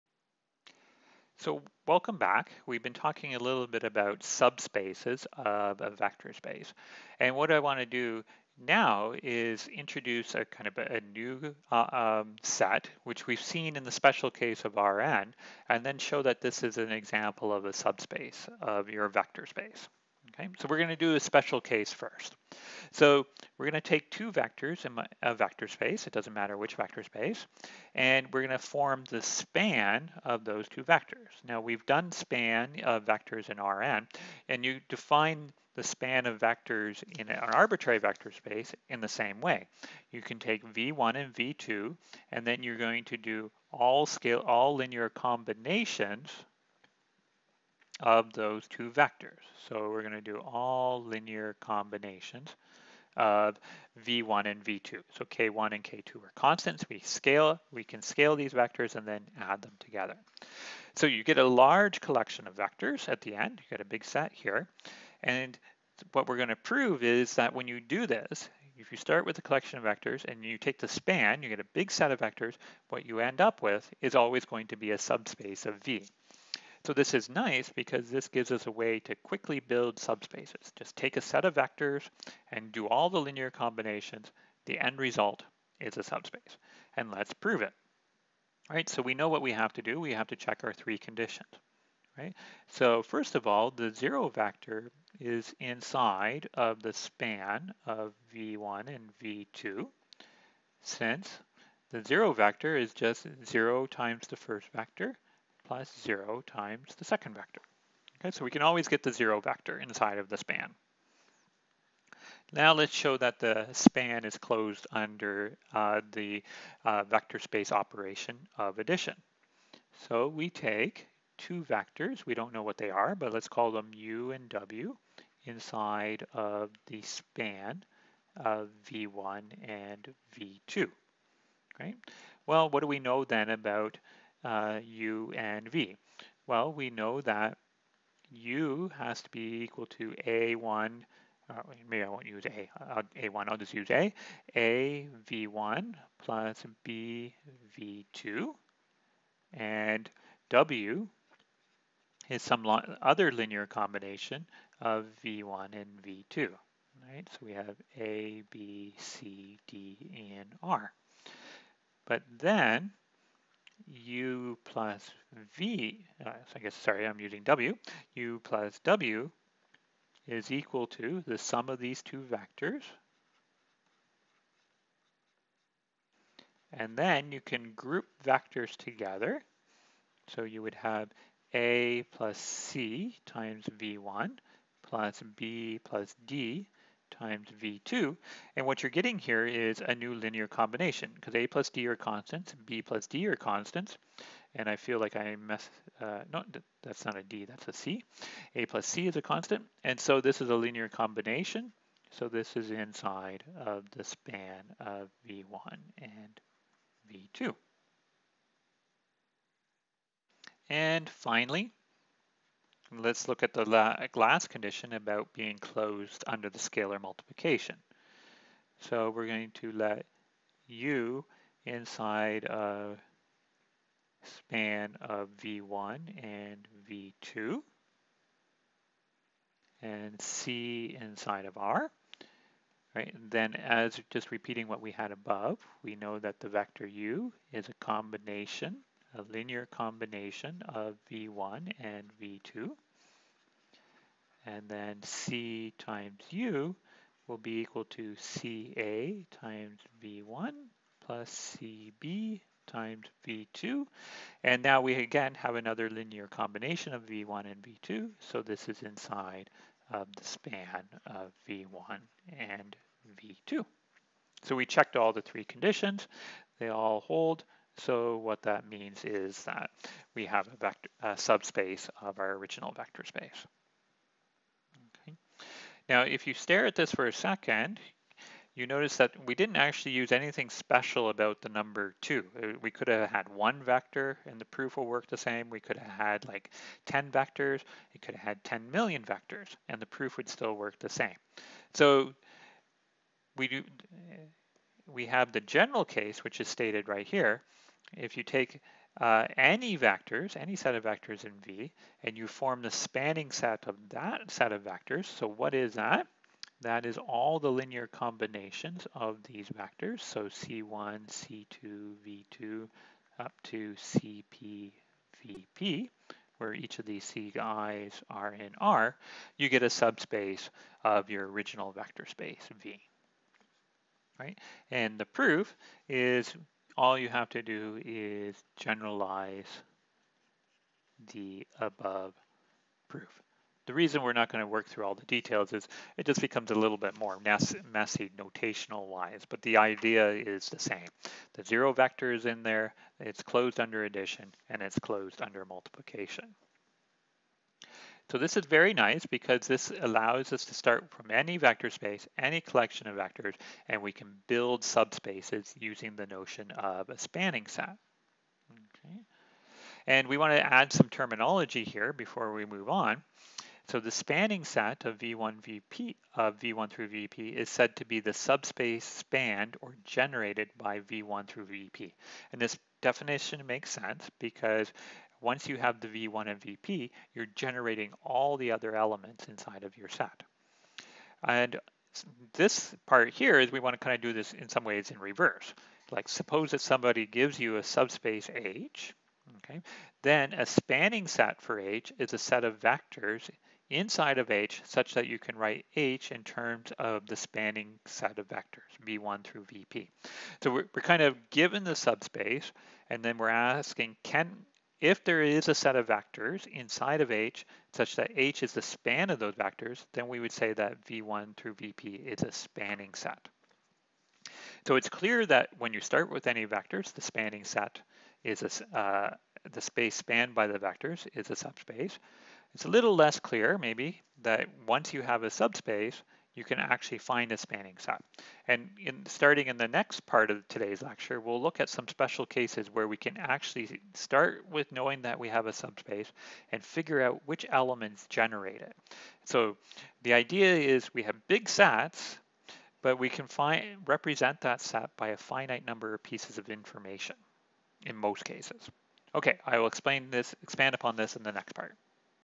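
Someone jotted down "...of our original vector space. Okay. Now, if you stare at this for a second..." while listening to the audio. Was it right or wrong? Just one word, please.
right.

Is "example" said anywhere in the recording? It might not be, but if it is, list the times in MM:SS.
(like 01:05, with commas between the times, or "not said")
00:16.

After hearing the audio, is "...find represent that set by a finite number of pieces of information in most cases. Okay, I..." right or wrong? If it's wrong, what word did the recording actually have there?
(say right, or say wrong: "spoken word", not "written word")
right.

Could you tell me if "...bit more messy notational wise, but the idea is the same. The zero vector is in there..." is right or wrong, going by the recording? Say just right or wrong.
right.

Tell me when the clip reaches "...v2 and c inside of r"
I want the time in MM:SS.
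03:46.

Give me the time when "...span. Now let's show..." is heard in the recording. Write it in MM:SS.
01:50.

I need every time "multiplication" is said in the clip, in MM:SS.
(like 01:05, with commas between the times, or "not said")
03:36, 05:45.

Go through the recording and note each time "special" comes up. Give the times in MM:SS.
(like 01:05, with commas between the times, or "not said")
00:13, 00:21, 04:40, 07:11.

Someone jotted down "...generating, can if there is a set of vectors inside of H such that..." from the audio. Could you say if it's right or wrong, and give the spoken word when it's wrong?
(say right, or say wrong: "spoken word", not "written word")
wrong: "asking", not "generating".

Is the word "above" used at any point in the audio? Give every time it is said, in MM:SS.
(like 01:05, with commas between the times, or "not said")
03:55, 05:31.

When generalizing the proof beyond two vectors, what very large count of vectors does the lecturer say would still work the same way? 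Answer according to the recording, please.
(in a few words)
10 million.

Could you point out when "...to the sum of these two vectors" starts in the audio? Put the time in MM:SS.
02:50.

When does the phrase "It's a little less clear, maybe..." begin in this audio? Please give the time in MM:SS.
07:02.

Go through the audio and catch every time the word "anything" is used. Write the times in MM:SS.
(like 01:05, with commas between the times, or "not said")
04:40.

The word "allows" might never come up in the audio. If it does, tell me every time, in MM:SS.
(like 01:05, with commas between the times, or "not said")
05:49.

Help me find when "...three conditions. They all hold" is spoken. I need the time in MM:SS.
04:25.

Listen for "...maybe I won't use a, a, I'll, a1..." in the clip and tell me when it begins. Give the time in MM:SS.
02:21.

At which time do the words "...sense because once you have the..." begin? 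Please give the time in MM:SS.
06:13.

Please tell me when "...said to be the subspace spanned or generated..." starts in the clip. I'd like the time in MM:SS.
06:07.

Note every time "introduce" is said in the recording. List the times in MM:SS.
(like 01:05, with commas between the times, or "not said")
00:09.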